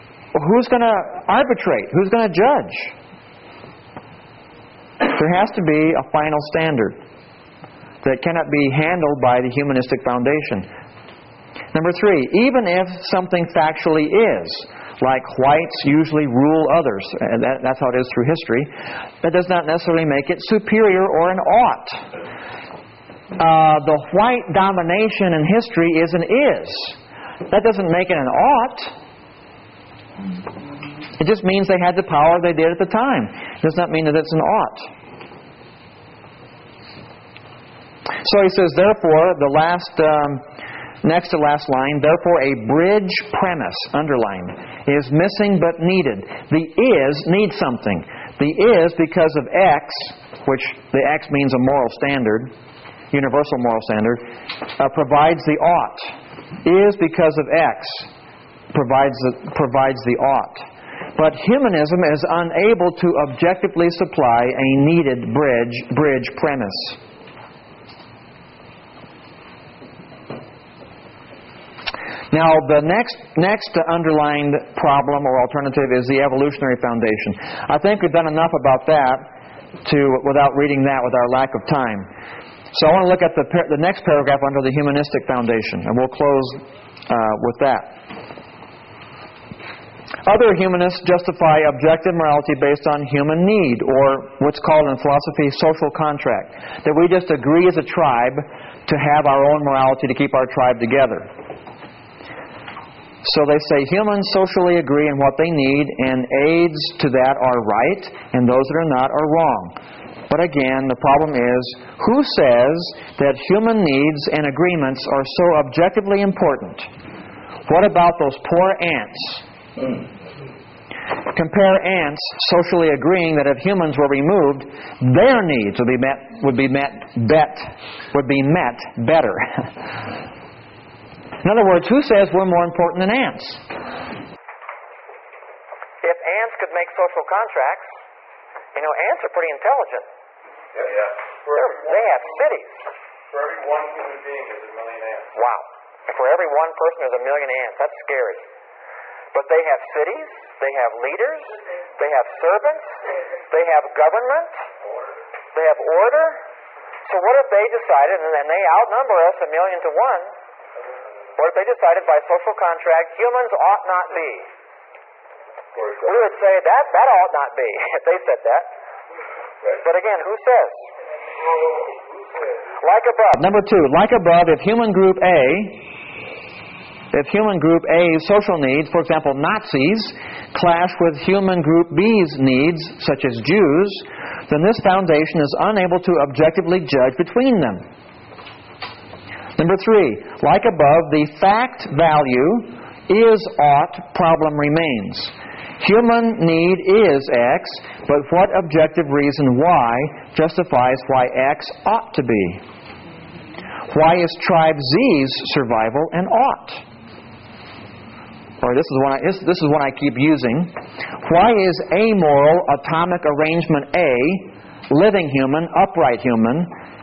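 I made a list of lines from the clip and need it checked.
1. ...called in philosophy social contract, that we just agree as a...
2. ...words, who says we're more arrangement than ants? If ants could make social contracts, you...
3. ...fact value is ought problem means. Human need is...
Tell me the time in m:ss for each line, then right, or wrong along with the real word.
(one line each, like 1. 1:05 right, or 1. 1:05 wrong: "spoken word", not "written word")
1. 1:34 right
2. 2:11 wrong: "important", not "arrangement"
3. 3:11 wrong: "remains", not "means".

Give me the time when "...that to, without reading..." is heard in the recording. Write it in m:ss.
1:18.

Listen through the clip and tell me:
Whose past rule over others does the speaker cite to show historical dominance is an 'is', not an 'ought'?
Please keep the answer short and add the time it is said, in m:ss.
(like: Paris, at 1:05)
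Whites, at 0:15.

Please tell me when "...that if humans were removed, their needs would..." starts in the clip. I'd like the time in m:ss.
2:03.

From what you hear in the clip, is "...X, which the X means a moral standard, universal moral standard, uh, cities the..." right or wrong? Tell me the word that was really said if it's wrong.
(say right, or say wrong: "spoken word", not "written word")
wrong: "provides", not "cities".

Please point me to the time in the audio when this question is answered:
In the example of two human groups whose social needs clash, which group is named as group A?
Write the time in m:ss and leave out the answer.
2:59.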